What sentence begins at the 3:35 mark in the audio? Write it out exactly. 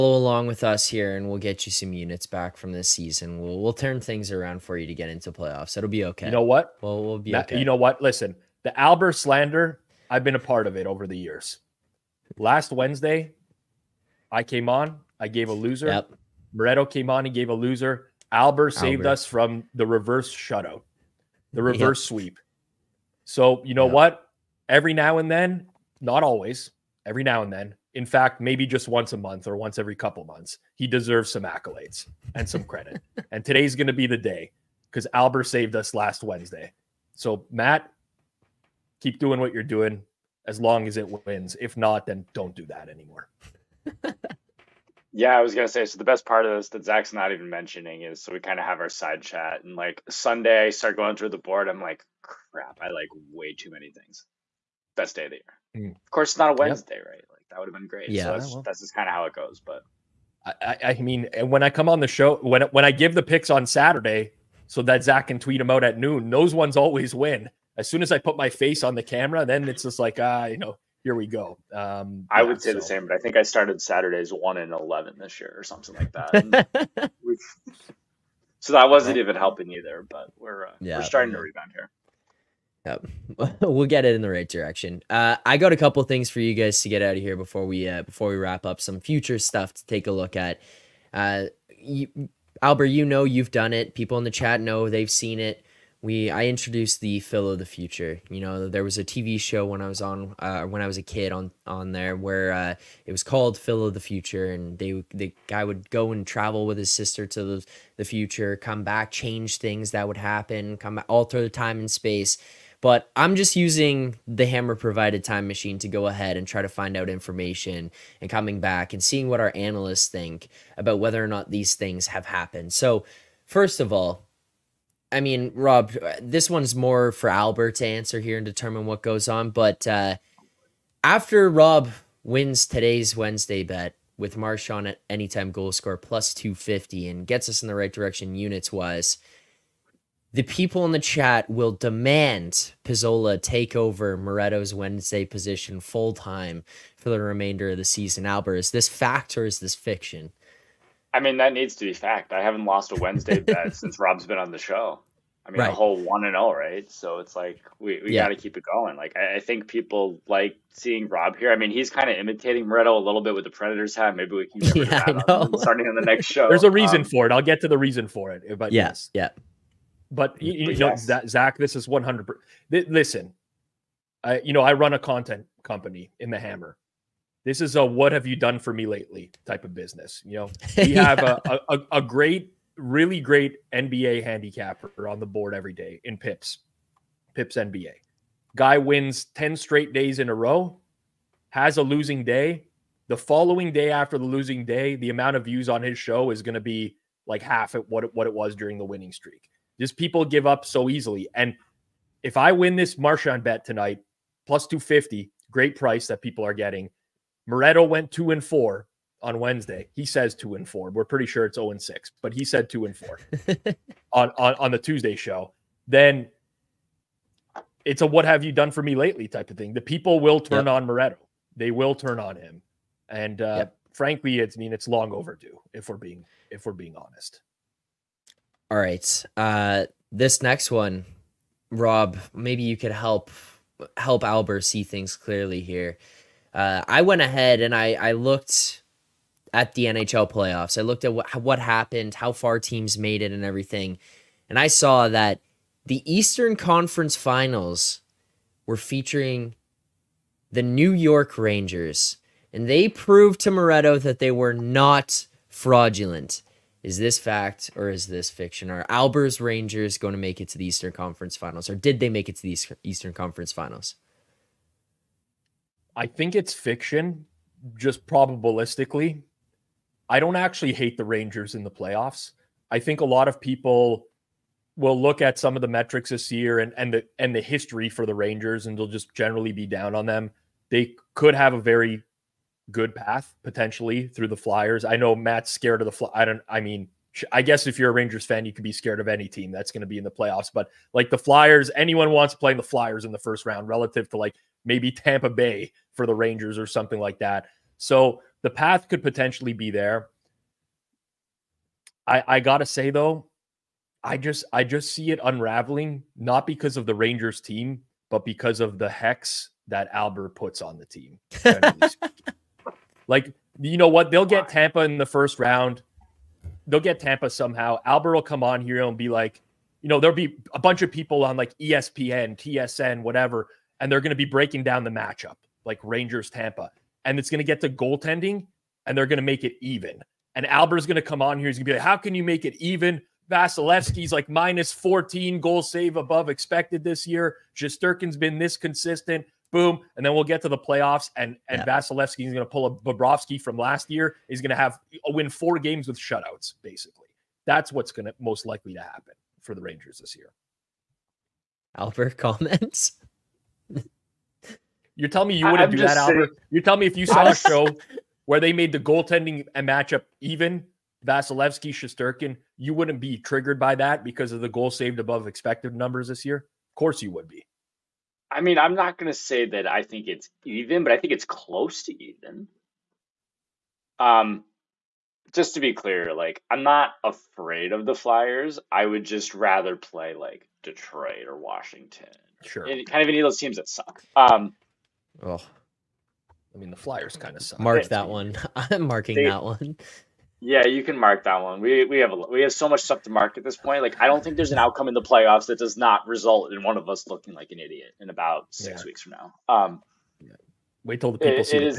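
Then it's a what have you done for me lately type of thing.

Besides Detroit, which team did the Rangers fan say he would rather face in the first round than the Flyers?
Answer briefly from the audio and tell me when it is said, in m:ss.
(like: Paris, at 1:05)
Washington, at 6:21.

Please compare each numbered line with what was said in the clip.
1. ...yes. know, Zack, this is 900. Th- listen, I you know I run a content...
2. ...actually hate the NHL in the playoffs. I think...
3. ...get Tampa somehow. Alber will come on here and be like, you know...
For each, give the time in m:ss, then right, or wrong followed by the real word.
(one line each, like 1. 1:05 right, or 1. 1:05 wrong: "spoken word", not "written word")
1. 2:50 wrong: "100", not "900"
2. 4:30 wrong: "Rangers", not "NHL"
3. 5:16 right.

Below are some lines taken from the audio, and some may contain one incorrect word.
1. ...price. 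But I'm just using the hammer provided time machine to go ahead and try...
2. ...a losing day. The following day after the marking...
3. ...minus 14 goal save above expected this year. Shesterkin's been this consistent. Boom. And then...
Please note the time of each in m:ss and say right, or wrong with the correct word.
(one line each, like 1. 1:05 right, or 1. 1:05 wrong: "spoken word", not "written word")
1. 1:51 wrong: "space", not "price"
2. 3:11 wrong: "losing", not "marking"
3. 5:34 right.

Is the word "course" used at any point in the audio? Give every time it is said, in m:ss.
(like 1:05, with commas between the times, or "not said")
0:56, 6:06.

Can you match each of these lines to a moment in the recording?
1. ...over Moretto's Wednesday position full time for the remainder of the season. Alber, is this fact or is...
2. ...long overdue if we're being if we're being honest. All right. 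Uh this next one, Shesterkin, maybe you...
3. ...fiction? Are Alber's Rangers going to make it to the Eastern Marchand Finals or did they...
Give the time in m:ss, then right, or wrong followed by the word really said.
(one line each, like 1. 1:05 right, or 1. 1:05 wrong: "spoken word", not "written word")
1. 2:23 right
2. 3:44 wrong: "Rob", not "Shesterkin"
3. 4:18 wrong: "Conference", not "Marchand".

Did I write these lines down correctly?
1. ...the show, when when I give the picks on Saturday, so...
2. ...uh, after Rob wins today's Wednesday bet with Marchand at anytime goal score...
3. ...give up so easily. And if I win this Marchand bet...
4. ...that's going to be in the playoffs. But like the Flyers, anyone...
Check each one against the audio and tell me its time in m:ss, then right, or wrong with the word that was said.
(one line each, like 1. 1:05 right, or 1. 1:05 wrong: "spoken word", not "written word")
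1. 1:01 right
2. 2:09 right
3. 3:20 right
4. 4:49 right.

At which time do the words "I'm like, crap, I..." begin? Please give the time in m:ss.
0:51.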